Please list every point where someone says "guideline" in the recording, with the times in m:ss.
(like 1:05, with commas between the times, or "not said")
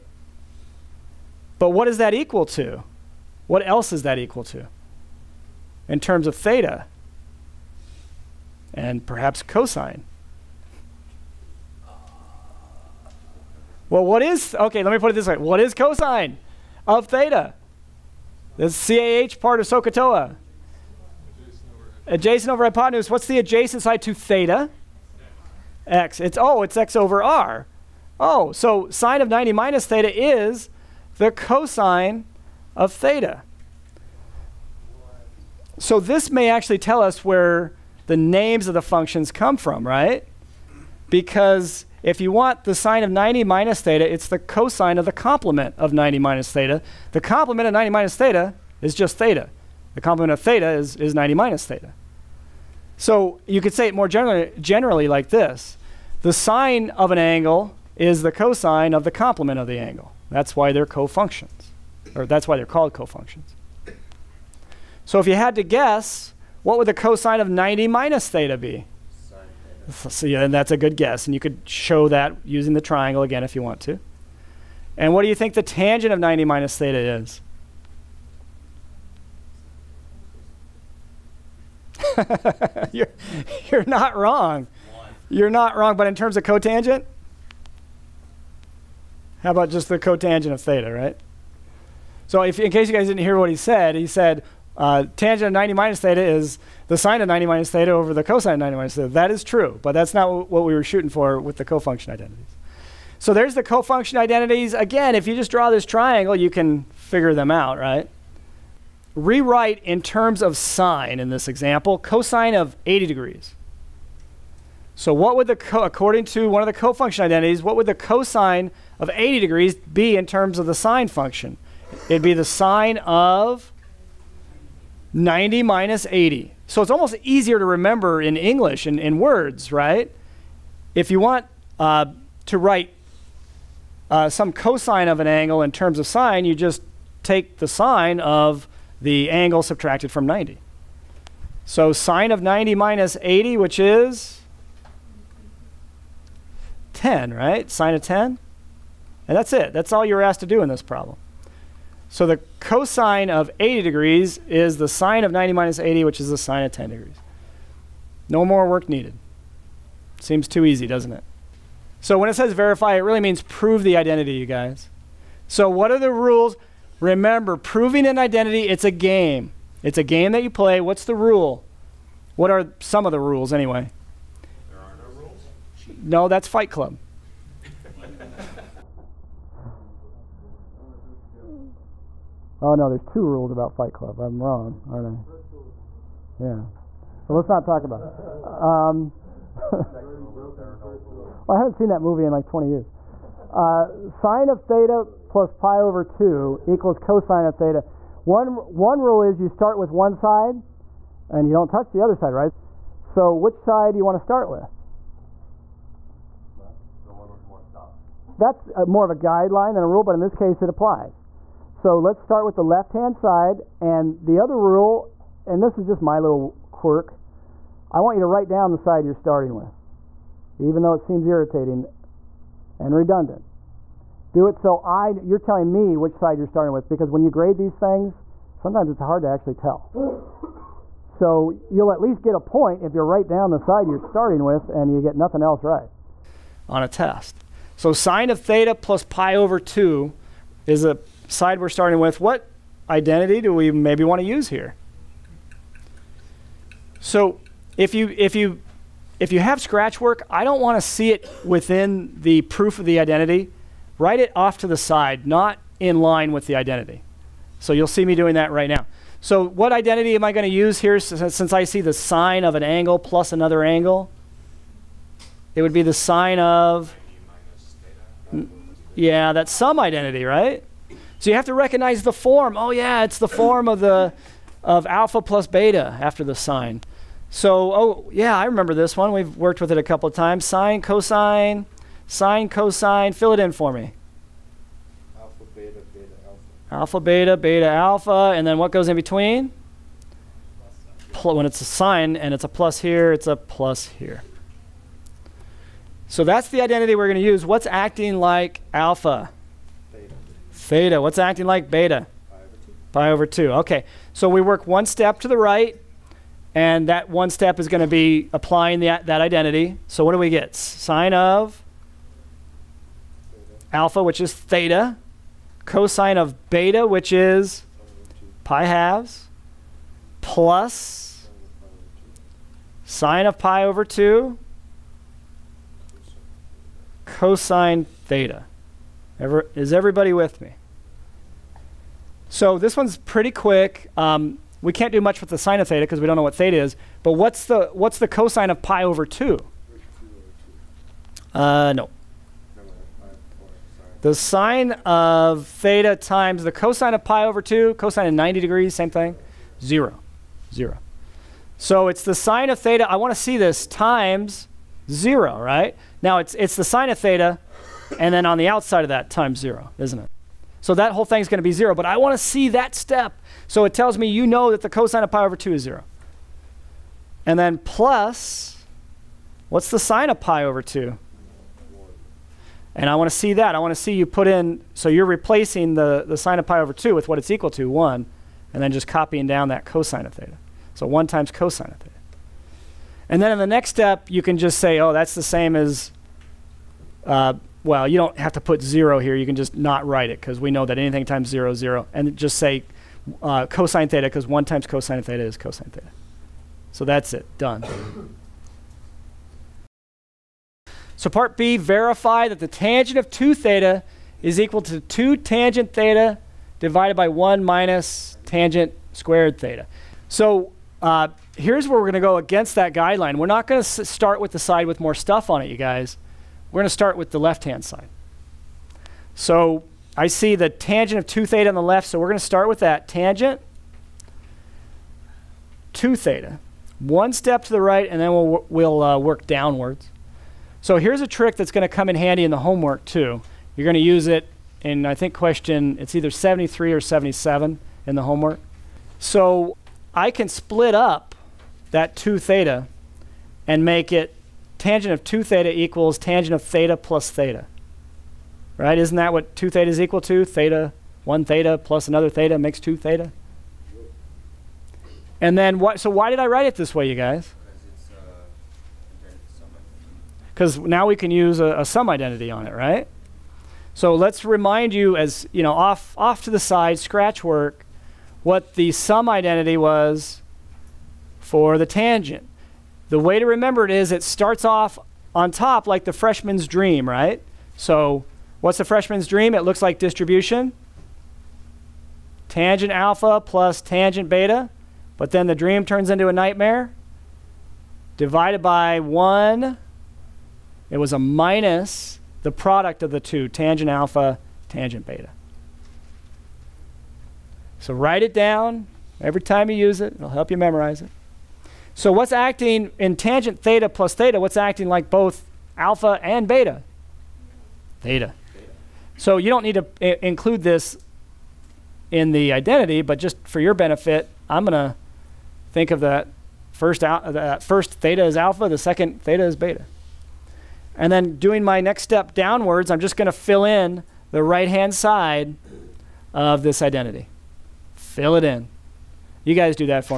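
3:29, 6:52.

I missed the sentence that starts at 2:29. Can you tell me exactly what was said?
That's all you're asked to do in this problem.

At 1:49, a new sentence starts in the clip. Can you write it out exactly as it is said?
Rewrite in terms of sine in this example, cosine of 80 degrees.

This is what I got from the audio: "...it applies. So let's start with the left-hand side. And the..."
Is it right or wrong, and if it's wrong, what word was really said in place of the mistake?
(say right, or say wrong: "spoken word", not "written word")
right.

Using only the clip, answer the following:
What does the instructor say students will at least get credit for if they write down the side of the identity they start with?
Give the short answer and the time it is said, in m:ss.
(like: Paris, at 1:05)
a point, at 3:52.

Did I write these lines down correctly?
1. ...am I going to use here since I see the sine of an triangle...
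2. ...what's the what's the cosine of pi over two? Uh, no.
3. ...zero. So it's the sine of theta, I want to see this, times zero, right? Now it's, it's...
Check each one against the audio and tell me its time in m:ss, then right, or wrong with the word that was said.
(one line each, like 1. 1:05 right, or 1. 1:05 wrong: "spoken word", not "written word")
1. 4:20 wrong: "angle", not "triangle"
2. 5:37 right
3. 5:50 right.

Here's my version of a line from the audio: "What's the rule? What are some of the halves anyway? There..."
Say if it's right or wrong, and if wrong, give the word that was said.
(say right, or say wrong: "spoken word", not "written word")
wrong: "rules", not "halves".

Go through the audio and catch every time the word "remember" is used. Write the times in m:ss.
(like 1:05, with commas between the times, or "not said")
2:07, 2:47, 4:38, 7:53.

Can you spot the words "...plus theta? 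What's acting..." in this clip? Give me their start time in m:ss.
8:23.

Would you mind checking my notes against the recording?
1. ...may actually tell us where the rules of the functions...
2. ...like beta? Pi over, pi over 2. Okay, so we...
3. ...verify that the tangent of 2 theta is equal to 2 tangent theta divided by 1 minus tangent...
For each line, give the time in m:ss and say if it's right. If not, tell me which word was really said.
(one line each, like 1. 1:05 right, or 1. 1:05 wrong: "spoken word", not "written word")
1. 0:36 wrong: "names", not "rules"
2. 5:01 right
3. 6:41 right.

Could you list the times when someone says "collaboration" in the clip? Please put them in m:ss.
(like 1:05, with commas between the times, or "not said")
not said.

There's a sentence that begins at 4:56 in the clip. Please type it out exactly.
So that's the identity we're going to use.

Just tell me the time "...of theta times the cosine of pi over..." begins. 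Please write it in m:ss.
5:44.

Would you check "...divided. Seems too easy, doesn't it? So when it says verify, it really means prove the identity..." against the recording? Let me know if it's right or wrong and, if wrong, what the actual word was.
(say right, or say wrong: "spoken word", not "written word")
wrong: "needed", not "divided".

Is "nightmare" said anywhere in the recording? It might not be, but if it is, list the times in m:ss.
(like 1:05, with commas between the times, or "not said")
8:06.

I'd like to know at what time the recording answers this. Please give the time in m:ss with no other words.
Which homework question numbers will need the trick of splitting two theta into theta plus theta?
7:16.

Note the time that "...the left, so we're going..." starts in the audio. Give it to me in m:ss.
7:01.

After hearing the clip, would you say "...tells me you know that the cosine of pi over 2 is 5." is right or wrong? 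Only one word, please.
wrong.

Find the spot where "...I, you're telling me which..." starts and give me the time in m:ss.
3:44.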